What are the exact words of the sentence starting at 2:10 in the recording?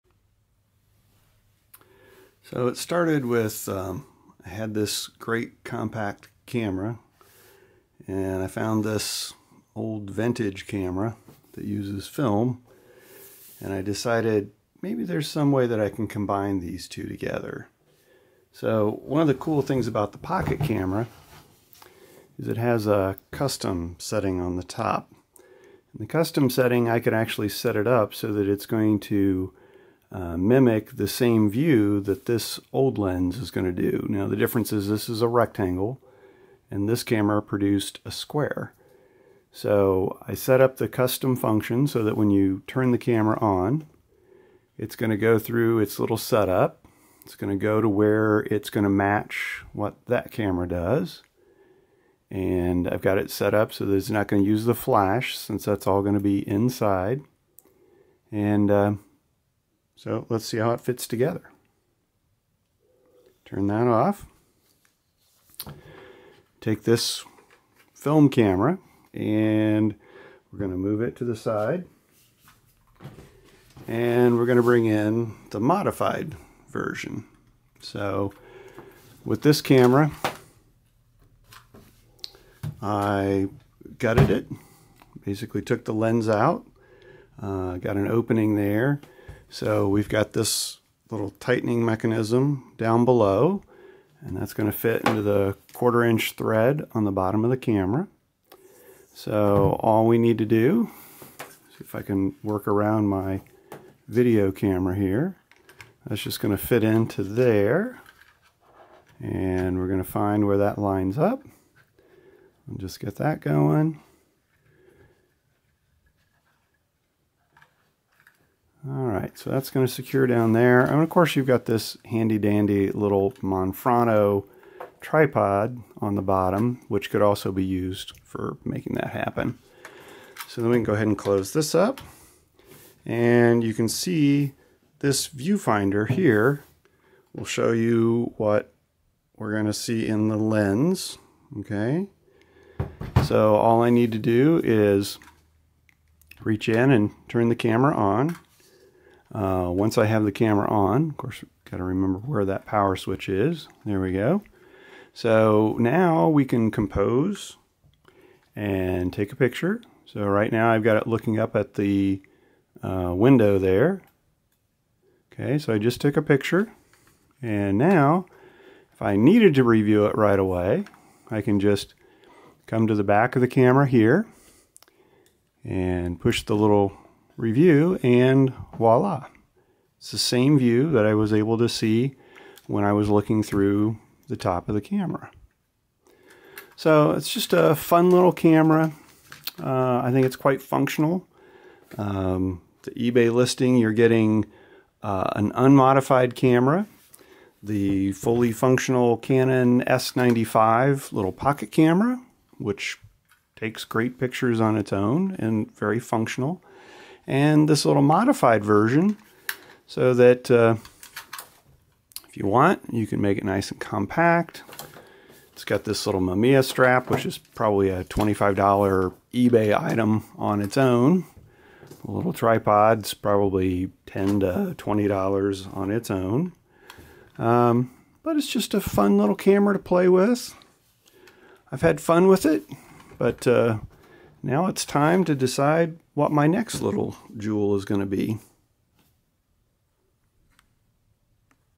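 So then we can go ahead and close this up.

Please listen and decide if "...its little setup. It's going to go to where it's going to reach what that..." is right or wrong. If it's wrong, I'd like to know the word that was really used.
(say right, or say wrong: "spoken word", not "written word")
wrong: "match", not "reach".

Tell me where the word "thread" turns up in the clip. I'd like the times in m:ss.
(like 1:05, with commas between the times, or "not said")
1:36.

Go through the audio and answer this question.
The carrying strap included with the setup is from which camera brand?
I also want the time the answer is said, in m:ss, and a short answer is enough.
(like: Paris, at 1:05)
Mamiya, at 3:36.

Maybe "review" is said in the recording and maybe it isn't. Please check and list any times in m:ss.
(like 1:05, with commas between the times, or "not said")
2:49, 2:57.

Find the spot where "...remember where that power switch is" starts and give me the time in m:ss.
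2:31.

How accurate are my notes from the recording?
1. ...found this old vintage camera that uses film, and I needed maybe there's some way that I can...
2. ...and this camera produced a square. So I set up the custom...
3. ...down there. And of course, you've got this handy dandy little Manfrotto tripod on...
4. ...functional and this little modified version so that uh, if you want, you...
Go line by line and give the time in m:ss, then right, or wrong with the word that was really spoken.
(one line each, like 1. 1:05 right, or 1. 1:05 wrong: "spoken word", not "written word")
1. 0:08 wrong: "decided", not "needed"
2. 0:36 right
3. 2:00 right
4. 3:25 right.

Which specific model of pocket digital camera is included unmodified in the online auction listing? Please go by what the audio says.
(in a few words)
Canon S95.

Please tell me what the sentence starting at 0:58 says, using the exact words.
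And uh, so let's see how it fits together.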